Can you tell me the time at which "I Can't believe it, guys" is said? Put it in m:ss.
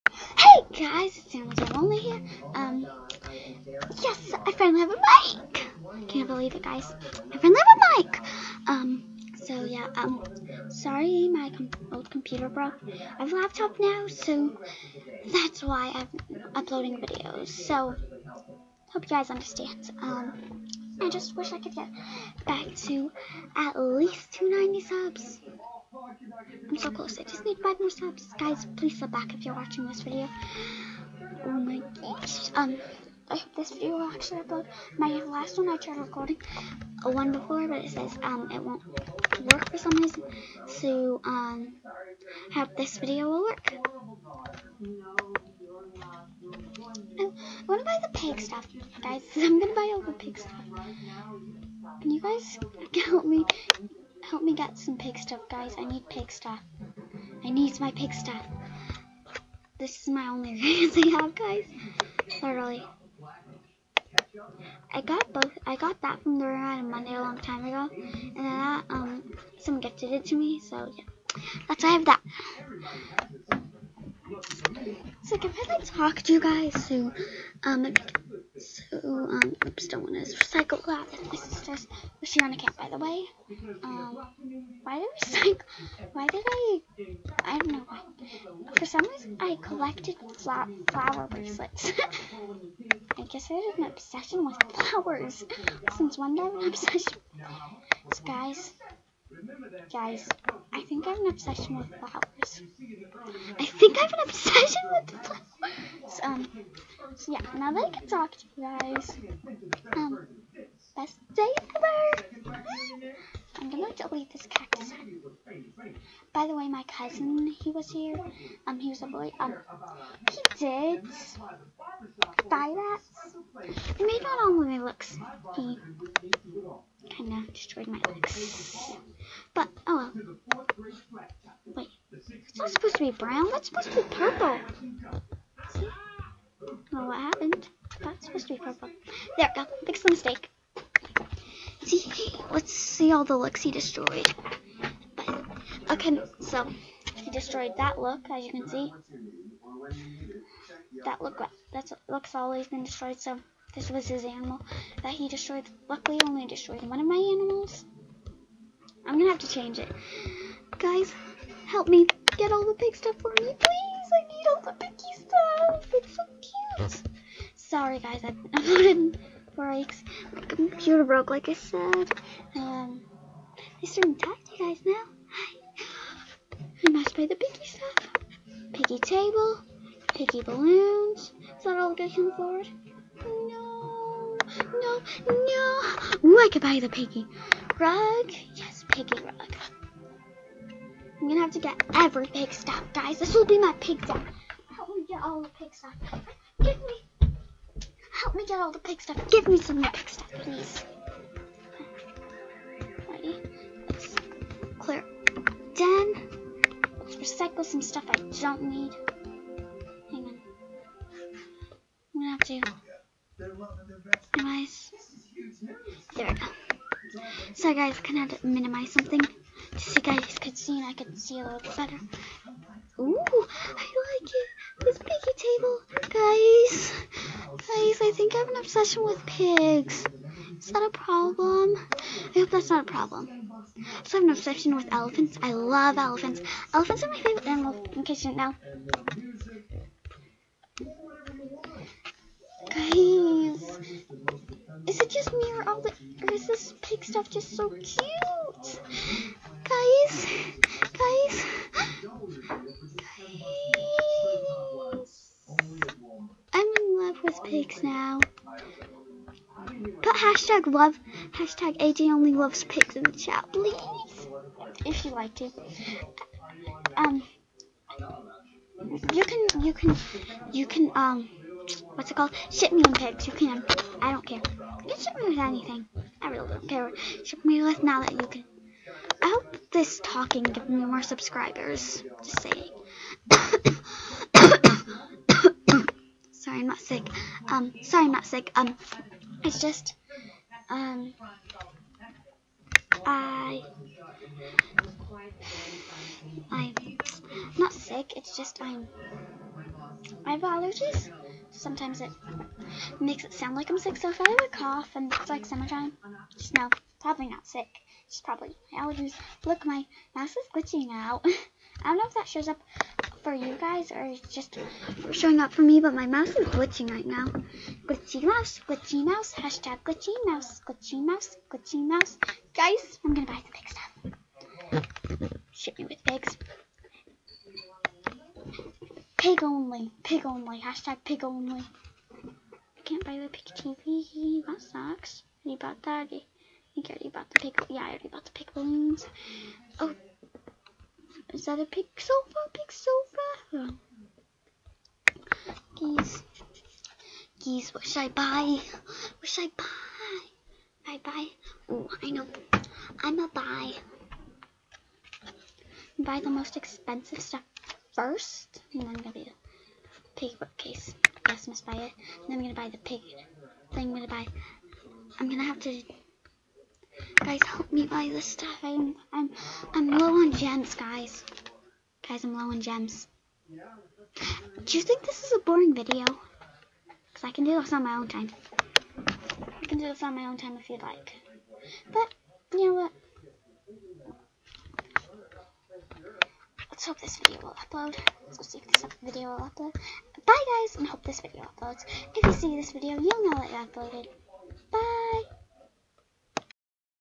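0:05.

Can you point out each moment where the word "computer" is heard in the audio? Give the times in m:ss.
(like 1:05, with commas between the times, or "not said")
0:12, 2:50.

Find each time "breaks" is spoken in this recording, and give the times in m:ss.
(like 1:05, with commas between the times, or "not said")
2:49.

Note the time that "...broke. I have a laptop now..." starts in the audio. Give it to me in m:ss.
0:12.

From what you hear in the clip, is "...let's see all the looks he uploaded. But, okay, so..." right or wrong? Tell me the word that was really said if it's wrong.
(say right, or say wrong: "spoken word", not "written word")
wrong: "destroyed", not "uploaded".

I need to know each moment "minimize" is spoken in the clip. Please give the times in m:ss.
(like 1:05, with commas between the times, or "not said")
3:34, 3:38.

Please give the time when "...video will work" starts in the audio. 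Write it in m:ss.
0:42.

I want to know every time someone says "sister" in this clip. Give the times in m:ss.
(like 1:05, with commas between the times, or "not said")
1:21.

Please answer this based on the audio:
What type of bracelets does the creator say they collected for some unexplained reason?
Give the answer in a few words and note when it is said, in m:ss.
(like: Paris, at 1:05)
flower bracelets, at 1:30.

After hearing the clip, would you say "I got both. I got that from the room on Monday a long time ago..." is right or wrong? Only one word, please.
right.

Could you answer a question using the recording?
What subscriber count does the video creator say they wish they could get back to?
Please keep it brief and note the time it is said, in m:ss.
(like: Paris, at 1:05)
290, at 0:24.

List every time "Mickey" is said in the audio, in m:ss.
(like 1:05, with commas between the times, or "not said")
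2:44, 2:57.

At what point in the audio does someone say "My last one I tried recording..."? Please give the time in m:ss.
0:34.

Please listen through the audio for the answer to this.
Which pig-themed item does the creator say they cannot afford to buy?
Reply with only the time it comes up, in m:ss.
5:33.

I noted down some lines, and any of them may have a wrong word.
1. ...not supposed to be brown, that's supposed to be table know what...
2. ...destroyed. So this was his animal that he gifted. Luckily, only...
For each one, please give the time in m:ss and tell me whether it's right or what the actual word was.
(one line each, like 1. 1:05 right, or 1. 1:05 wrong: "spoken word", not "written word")
1. 2:12 wrong: "purple", not "table"
2. 2:32 wrong: "destroyed", not "gifted".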